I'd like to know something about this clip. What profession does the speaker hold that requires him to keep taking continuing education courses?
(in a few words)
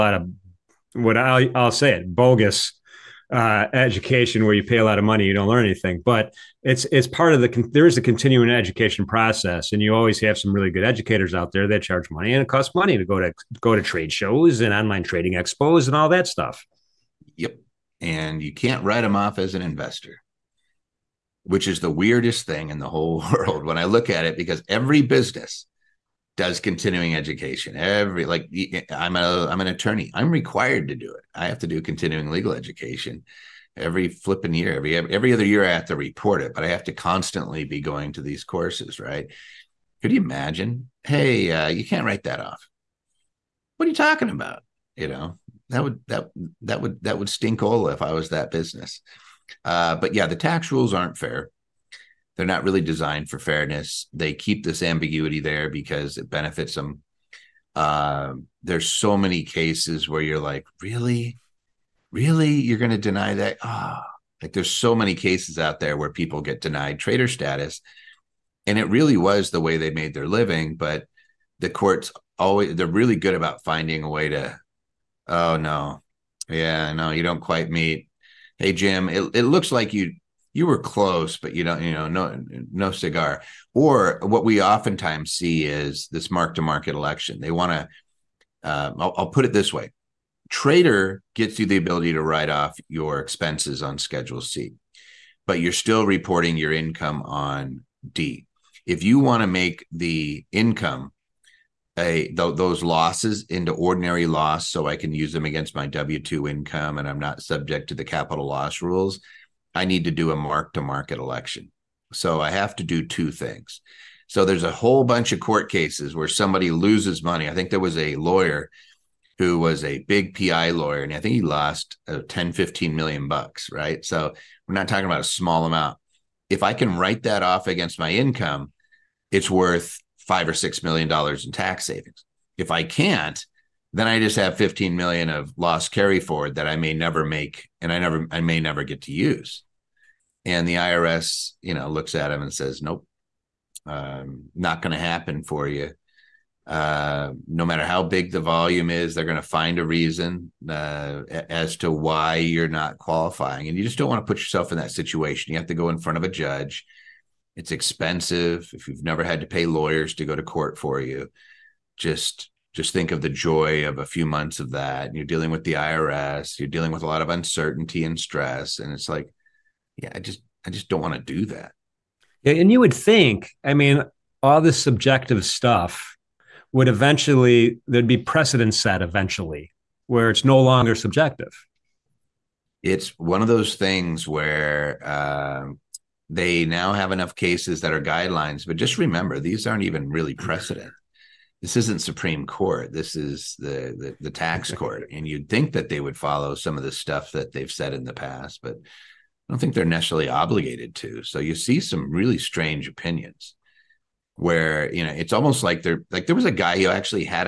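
attorney.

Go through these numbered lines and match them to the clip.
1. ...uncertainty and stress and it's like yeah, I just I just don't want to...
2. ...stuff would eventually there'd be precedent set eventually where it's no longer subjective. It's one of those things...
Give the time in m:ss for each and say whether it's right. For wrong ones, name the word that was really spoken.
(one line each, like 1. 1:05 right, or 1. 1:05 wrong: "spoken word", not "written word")
1. 2:47 right
2. 2:55 right.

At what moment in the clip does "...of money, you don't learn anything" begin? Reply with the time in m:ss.
0:04.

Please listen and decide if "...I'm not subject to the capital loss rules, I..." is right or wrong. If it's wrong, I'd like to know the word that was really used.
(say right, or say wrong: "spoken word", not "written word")
right.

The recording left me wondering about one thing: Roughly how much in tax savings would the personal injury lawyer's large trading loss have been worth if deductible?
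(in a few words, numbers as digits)
5 or 6 million dollars.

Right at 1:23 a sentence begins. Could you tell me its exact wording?
Or what we oftentimes see is this mark to market election.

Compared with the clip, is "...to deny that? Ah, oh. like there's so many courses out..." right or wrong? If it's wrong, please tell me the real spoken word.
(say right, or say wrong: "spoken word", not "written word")
wrong: "cases", not "courses".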